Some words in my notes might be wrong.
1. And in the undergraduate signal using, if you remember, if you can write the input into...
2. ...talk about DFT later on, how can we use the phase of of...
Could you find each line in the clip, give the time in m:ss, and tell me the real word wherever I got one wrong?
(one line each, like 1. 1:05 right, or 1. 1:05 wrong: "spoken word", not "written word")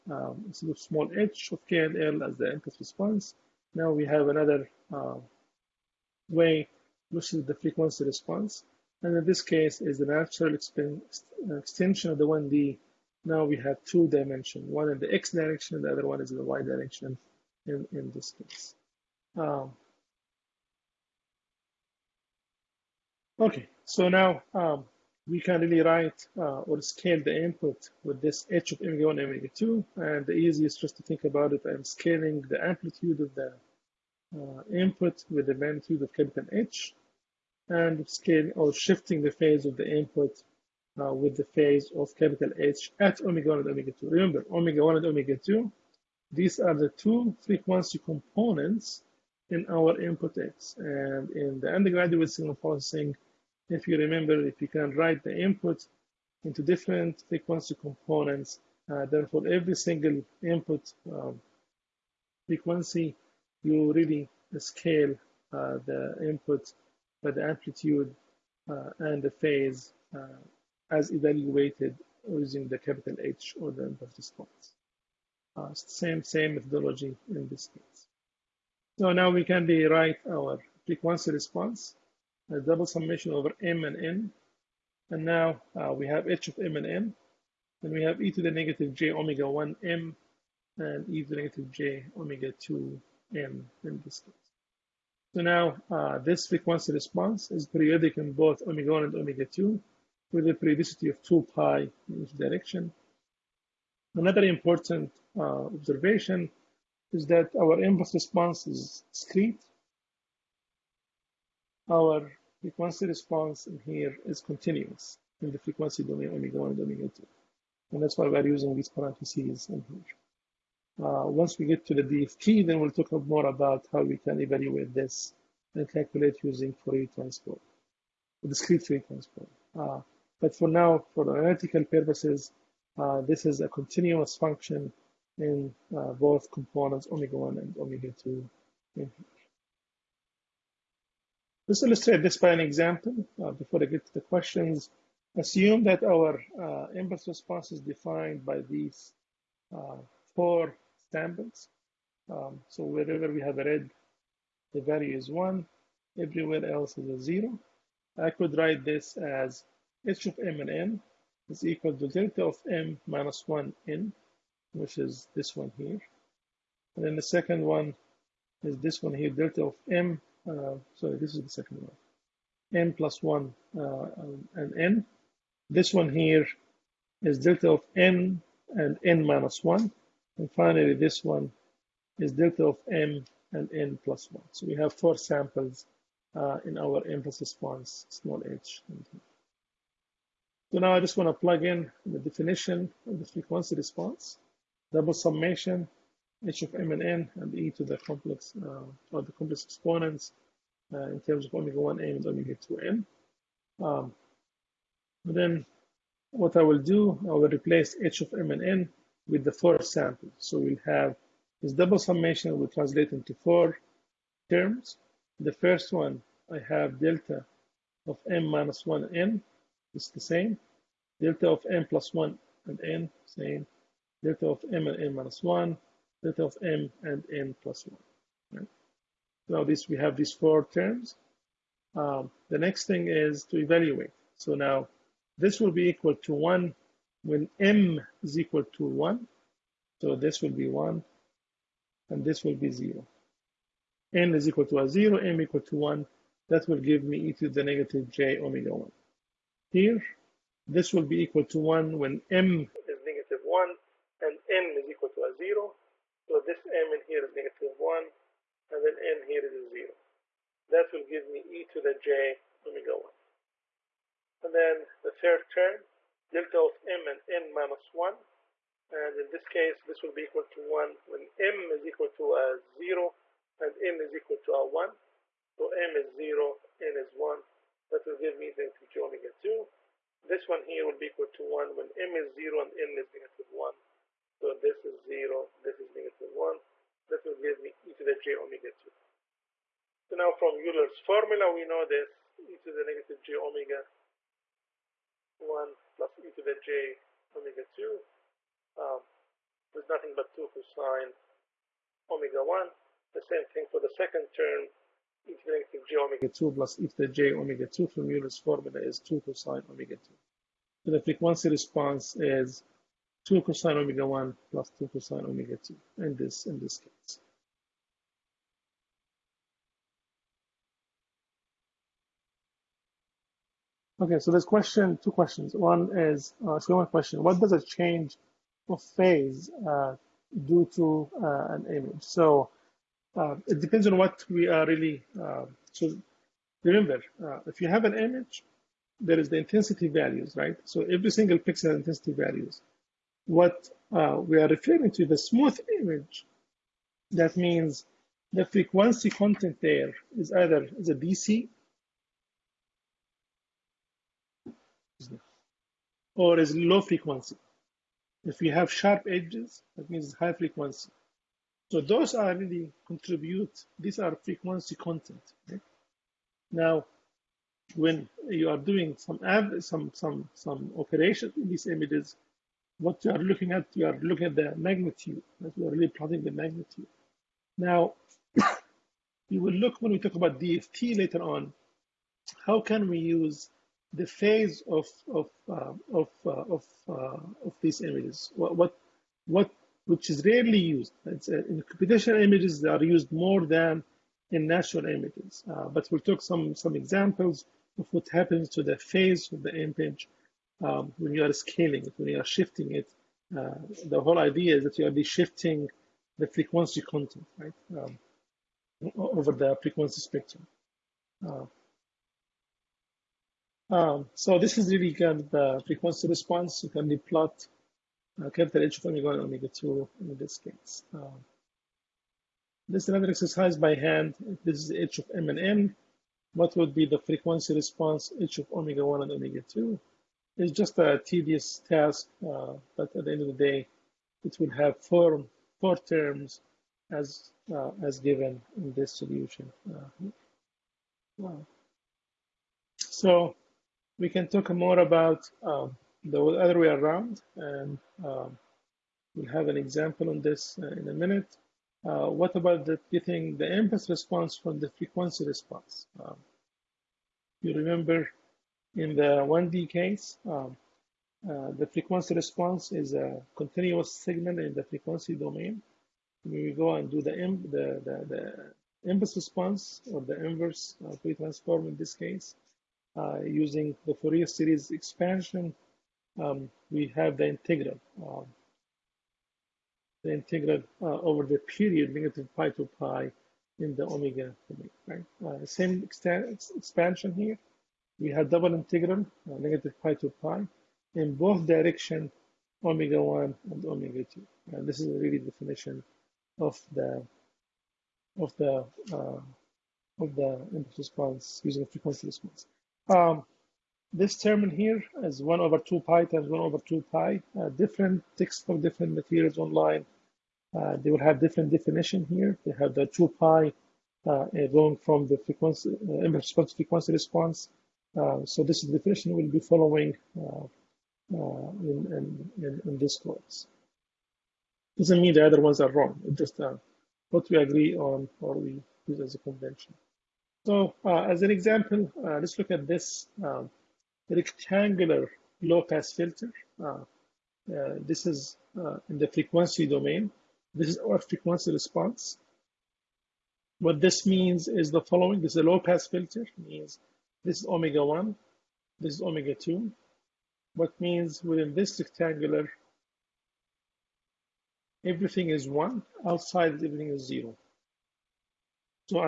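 1. 0:50 wrong: "processing", not "using"
2. 6:19 right.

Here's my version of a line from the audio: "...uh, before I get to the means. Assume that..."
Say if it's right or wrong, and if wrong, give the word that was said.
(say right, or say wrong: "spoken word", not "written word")
wrong: "questions", not "means".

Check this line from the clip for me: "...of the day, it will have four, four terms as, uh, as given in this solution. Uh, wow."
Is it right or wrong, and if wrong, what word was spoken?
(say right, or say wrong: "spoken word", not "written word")
right.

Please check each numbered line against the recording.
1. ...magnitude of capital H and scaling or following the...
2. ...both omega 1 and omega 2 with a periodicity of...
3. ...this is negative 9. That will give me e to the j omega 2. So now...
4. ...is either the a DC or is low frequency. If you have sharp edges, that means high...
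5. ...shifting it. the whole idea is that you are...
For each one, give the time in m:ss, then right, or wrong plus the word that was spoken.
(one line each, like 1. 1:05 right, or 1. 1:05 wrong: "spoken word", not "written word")
1. 0:35 wrong: "shifting", not "following"
2. 1:38 right
3. 4:45 wrong: "1", not "9"
4. 5:50 right
5. 6:42 right.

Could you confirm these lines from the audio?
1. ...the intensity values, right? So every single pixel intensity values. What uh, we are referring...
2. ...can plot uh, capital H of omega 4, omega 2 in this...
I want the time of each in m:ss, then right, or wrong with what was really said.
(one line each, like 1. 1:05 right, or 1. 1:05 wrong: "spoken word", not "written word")
1. 5:39 right
2. 6:56 wrong: "1", not "4".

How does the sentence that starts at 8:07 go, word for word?
We have double integral, uh, negative pi to pi, in both direction, omega 1 and omega 2.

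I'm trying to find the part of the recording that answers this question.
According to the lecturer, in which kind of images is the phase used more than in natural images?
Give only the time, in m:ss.
6:31.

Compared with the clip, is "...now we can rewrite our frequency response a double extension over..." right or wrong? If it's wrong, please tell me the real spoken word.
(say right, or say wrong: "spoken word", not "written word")
wrong: "summation", not "extension".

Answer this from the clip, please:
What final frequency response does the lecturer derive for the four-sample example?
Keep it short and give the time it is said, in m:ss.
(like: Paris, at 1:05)
2 cos omega 1 + 2 cos omega 2, at 5:13.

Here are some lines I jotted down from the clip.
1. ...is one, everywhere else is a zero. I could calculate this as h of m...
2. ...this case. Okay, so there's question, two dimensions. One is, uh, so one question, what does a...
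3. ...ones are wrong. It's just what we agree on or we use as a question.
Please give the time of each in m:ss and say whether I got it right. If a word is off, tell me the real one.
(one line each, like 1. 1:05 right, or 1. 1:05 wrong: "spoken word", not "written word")
1. 2:35 wrong: "write", not "calculate"
2. 5:16 wrong: "questions", not "dimensions"
3. 8:45 wrong: "convention", not "question".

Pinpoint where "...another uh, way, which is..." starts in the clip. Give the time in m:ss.
0:04.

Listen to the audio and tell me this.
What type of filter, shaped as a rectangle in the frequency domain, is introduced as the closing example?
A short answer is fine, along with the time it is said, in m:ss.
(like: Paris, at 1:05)
Rectangular low-pass filter, at 8:54.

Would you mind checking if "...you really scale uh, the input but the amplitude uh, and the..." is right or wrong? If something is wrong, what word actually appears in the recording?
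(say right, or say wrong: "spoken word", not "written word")
right.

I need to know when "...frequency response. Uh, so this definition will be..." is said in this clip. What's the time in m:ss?
8:36.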